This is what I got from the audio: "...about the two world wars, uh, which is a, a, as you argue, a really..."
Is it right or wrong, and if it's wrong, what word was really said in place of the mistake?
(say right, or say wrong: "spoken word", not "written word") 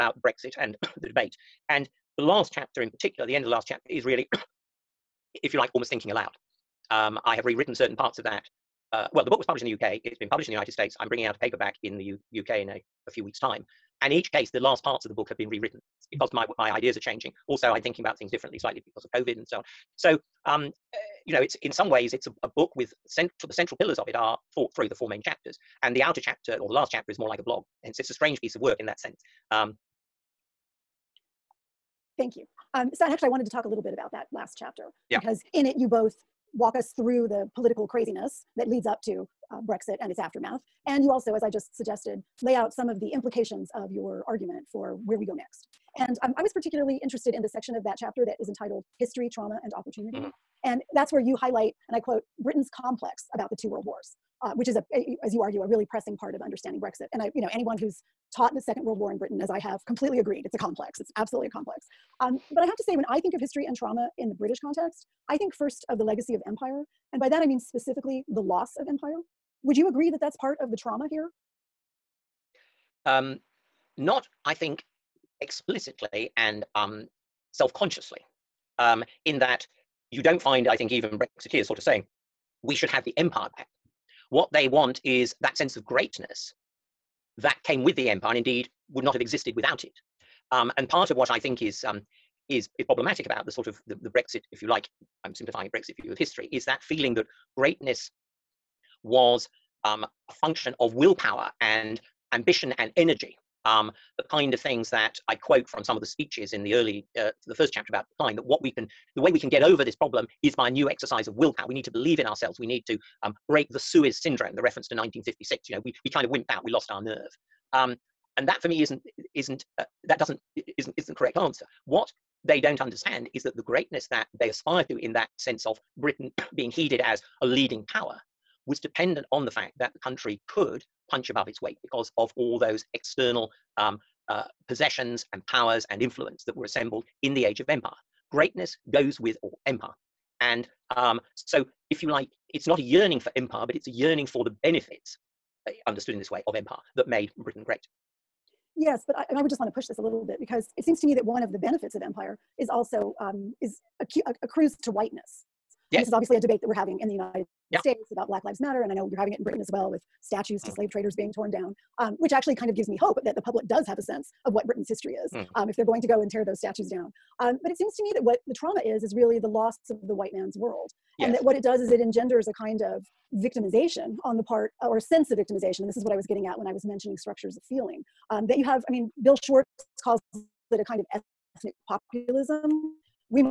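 right.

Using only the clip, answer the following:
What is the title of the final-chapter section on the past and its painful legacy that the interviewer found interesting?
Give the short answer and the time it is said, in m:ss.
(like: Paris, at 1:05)
History, Trauma, and Opportunity, at 0:48.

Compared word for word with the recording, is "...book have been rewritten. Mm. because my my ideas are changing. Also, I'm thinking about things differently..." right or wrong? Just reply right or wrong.
right.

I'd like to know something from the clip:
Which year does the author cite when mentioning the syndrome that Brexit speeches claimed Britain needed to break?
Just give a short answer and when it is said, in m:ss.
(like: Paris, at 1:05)
1956, at 1:54.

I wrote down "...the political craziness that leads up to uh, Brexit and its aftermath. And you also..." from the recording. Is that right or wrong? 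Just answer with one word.
right.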